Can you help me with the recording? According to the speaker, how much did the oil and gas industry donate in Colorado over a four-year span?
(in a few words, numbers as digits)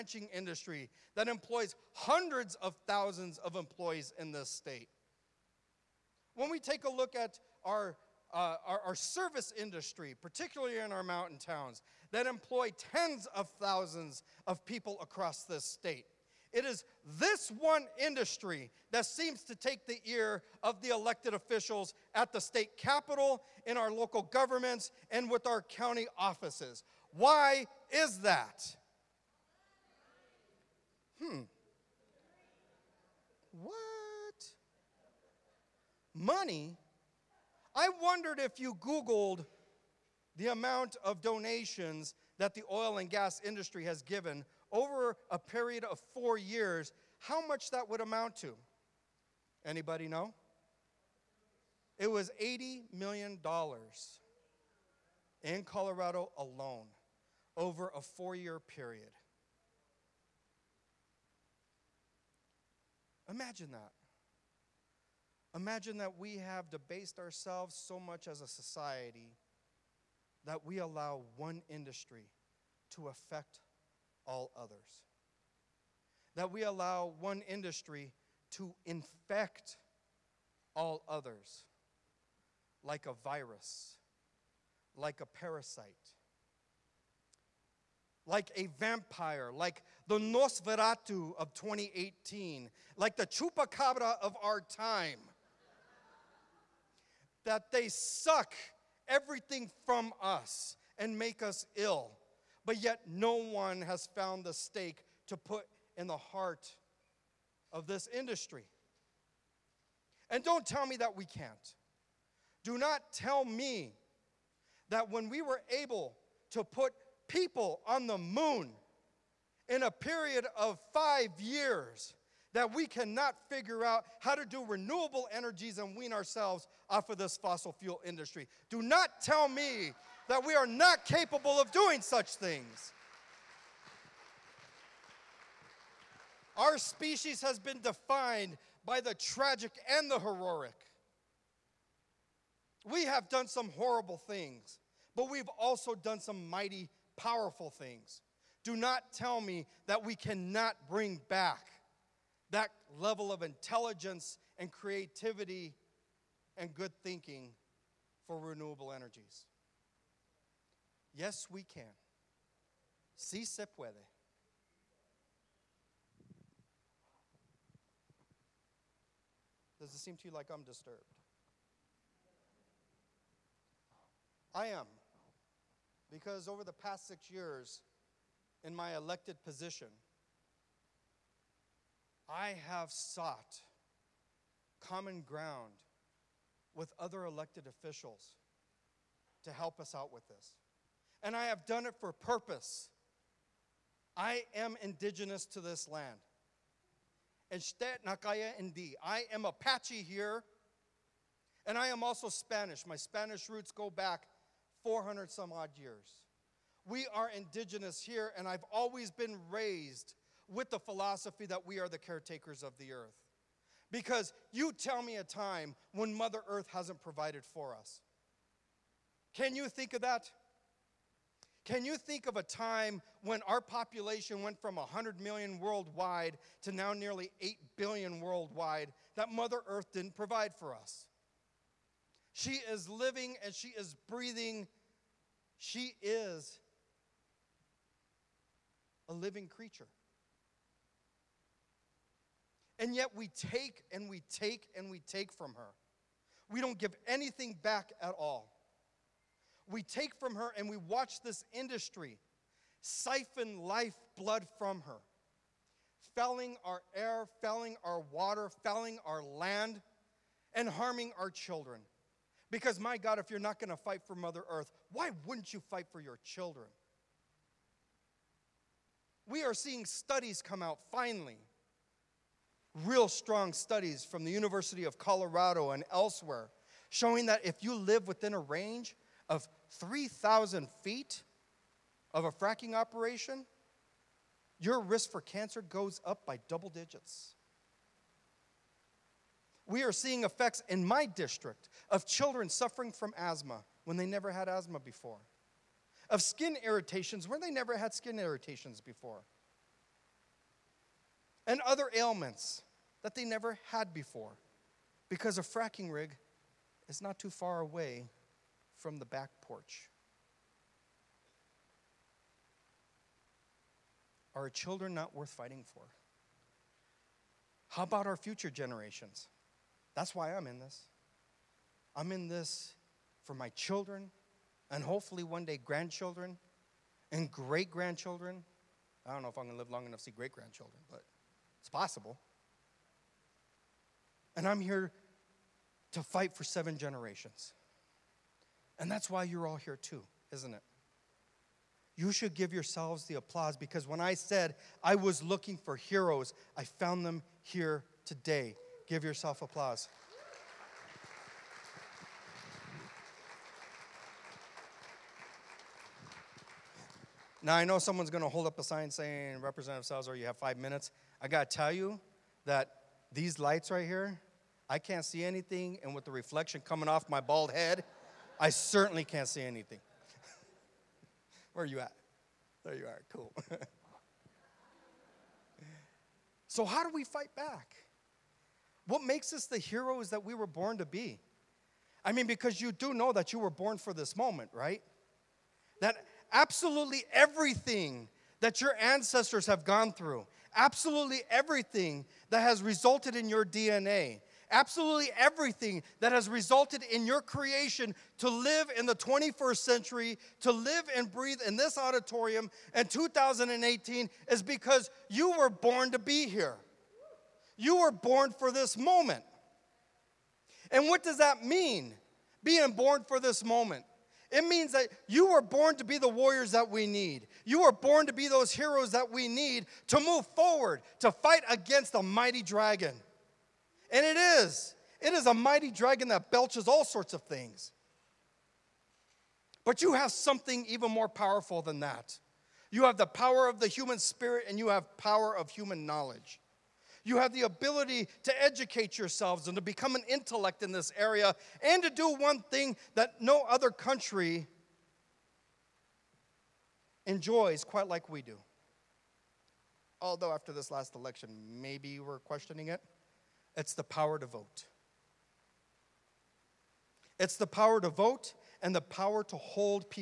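$80 million.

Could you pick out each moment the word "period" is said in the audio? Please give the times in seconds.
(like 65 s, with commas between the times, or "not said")
45 s, 58 s, 119 s.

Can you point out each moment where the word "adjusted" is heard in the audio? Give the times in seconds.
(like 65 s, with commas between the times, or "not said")
not said.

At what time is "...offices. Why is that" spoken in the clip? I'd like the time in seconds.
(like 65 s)
26 s.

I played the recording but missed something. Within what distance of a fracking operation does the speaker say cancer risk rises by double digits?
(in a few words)
3,000 feet.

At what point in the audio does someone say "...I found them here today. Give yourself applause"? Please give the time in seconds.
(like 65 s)
346 s.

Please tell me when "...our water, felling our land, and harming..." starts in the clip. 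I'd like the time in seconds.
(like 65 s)
257 s.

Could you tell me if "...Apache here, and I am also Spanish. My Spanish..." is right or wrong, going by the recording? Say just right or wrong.
right.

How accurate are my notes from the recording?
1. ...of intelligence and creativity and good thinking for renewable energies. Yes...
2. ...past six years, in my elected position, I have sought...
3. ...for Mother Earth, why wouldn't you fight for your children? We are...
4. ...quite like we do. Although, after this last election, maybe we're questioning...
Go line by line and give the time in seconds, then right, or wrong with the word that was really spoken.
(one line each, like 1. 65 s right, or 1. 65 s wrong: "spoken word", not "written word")
1. 153 s right
2. 176 s right
3. 264 s right
4. 447 s right.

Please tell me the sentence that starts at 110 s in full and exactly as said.
And don't tell me that we can't.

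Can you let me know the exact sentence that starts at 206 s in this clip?
We are indigenous here, and I've always been raised with the philosophy that we are the caretakers of the earth.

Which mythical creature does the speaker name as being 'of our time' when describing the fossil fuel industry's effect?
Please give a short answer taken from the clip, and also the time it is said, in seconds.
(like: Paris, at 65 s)
chupacabra, at 93 s.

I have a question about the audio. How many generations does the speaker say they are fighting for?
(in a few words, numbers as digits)
7.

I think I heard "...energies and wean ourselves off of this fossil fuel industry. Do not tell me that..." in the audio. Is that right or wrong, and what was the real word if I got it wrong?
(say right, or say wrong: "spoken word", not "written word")
right.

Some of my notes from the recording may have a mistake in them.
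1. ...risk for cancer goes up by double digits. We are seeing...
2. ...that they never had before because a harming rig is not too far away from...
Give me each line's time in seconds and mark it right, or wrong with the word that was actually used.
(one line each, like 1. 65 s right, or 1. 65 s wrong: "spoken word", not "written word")
1. 284 s right
2. 303 s wrong: "fracking", not "harming".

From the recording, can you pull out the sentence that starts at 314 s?
Are our children not worth fighting for?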